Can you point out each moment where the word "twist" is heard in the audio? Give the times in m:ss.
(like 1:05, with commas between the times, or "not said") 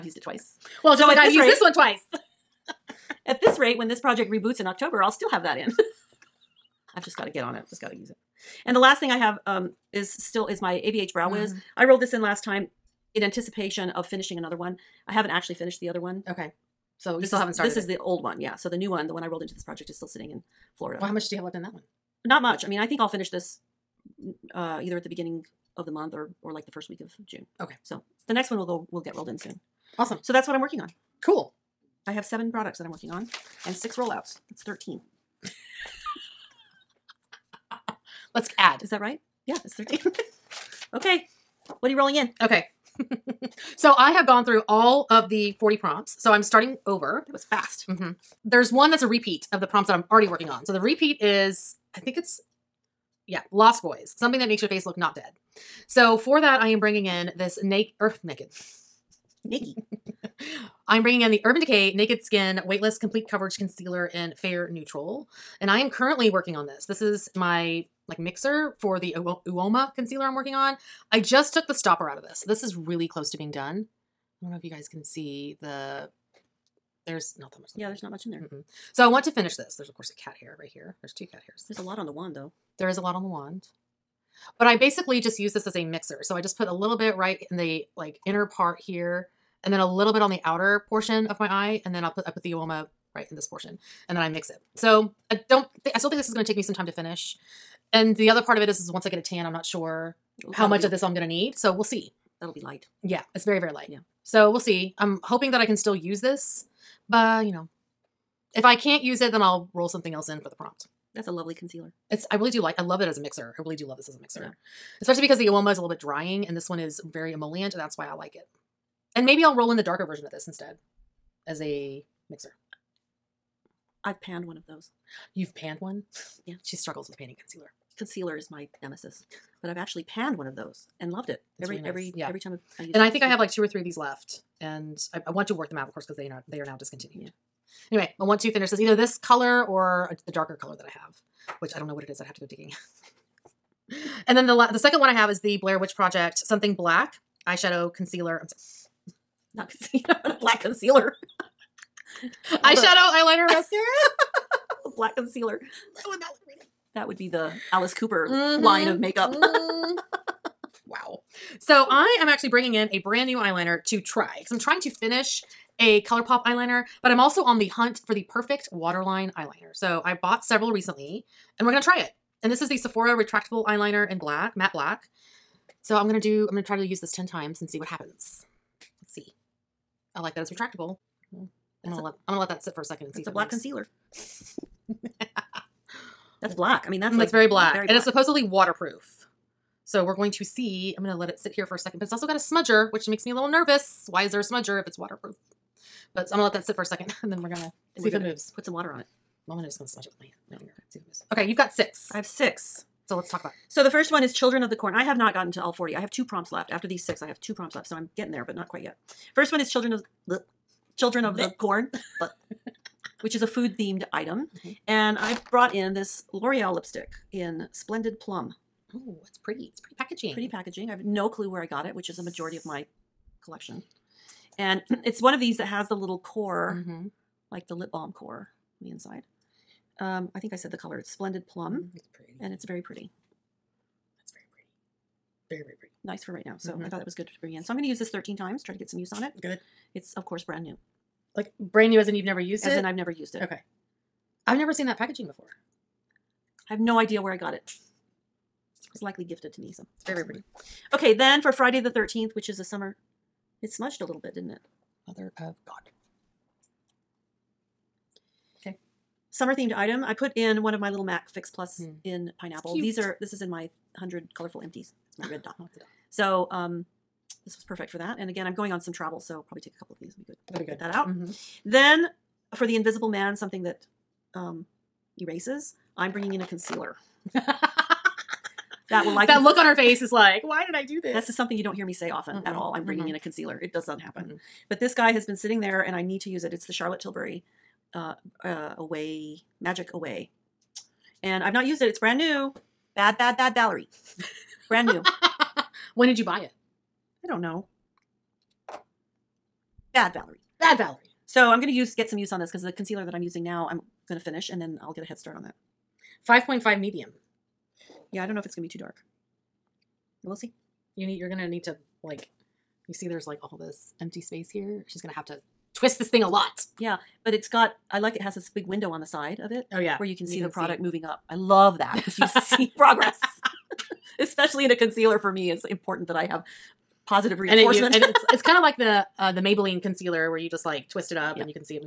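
5:15, 5:30.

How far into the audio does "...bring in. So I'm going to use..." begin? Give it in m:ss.
3:57.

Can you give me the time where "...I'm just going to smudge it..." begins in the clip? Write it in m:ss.
3:19.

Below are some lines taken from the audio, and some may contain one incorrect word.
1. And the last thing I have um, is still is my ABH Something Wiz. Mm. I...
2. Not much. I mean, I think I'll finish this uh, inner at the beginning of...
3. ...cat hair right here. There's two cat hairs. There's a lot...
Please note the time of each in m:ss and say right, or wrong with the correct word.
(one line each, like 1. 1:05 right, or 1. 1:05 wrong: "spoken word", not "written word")
1. 0:08 wrong: "Brow", not "Something"
2. 0:22 wrong: "either", not "inner"
3. 1:20 right.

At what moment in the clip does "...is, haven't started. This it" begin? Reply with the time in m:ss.
0:17.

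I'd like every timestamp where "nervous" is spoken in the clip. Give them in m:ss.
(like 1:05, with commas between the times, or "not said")
3:13.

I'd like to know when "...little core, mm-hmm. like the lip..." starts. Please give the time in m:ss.
3:45.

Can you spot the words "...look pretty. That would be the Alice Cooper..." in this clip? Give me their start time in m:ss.
2:36.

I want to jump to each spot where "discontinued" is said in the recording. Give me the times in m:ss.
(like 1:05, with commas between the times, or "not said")
2:16.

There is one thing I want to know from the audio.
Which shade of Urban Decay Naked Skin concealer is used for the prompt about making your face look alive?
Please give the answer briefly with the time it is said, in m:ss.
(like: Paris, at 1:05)
Fair Neutral, at 1:04.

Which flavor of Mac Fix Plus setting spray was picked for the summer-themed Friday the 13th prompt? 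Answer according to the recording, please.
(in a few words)
pineapple.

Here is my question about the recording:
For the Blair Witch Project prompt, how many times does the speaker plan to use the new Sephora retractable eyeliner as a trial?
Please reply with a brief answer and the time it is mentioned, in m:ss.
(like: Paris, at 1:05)
10, at 2:57.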